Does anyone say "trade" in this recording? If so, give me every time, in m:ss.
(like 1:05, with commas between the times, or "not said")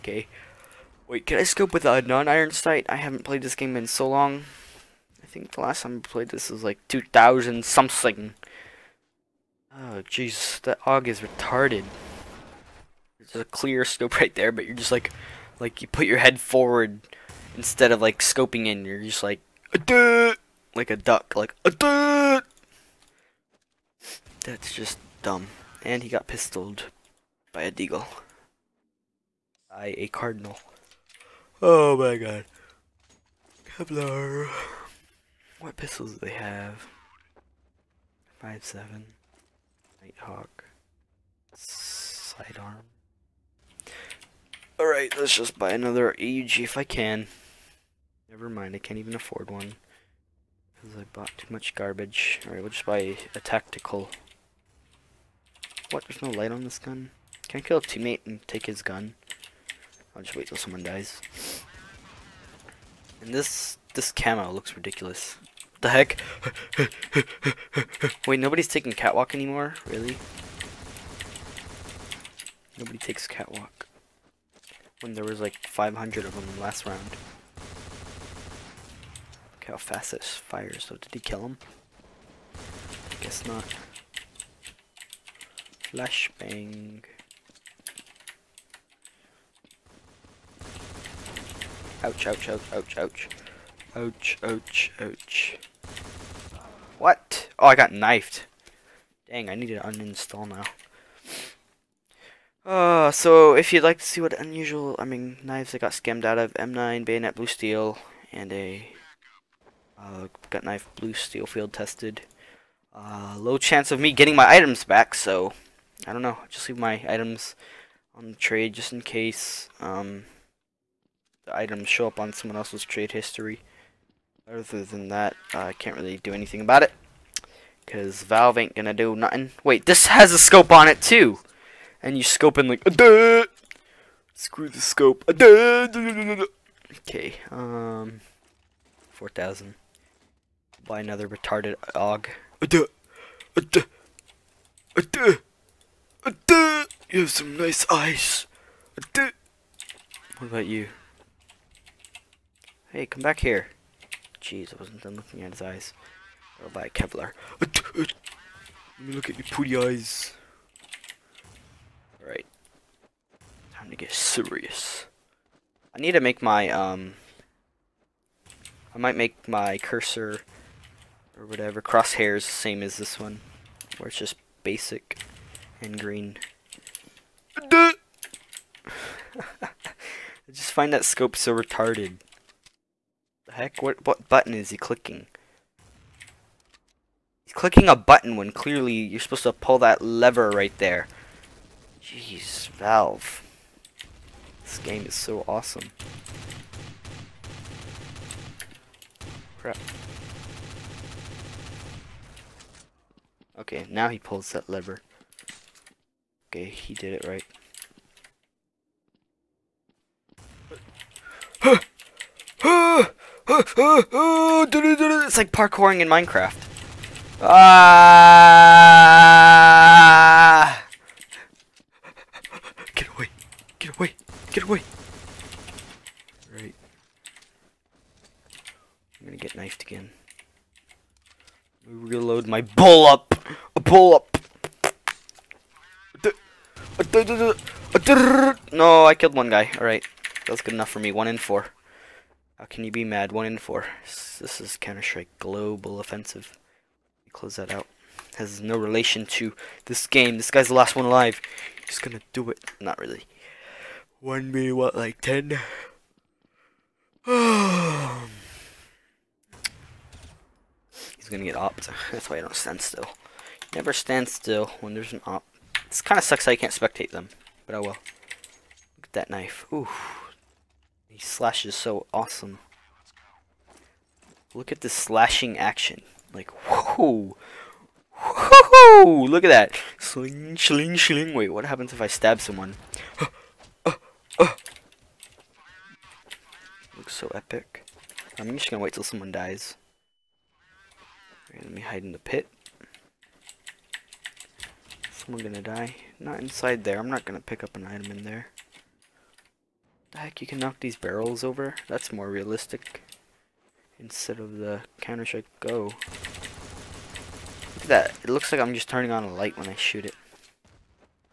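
1:58, 2:02.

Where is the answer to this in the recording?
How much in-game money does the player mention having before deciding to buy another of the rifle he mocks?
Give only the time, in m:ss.
2:19.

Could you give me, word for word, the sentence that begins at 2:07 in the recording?
Because Valve ain't gonna do nothing.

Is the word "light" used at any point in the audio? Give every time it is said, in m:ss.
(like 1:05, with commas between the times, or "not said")
0:56, 5:09.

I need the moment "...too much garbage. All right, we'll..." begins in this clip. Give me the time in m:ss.
0:51.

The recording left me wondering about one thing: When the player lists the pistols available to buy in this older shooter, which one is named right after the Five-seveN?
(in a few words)
Nighthawk.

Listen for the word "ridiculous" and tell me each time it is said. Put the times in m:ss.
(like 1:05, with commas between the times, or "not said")
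1:04.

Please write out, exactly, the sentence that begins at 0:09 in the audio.
Oh, jeez, that AUG is retarded.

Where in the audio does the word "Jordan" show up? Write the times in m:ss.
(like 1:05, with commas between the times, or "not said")
not said.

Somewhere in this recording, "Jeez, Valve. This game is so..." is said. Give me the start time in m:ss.
3:12.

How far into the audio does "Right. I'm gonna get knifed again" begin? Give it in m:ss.
3:46.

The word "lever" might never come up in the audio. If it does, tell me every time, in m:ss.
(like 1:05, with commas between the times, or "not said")
3:10, 3:24.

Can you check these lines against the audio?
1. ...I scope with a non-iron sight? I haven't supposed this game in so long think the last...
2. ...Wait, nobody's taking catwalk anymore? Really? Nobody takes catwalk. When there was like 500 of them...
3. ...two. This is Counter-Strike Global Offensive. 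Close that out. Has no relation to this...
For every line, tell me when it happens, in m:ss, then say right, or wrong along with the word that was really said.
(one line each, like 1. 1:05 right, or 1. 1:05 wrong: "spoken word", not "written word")
1. 0:01 wrong: "played", not "supposed"
2. 1:08 right
3. 4:03 wrong: "four", not "two".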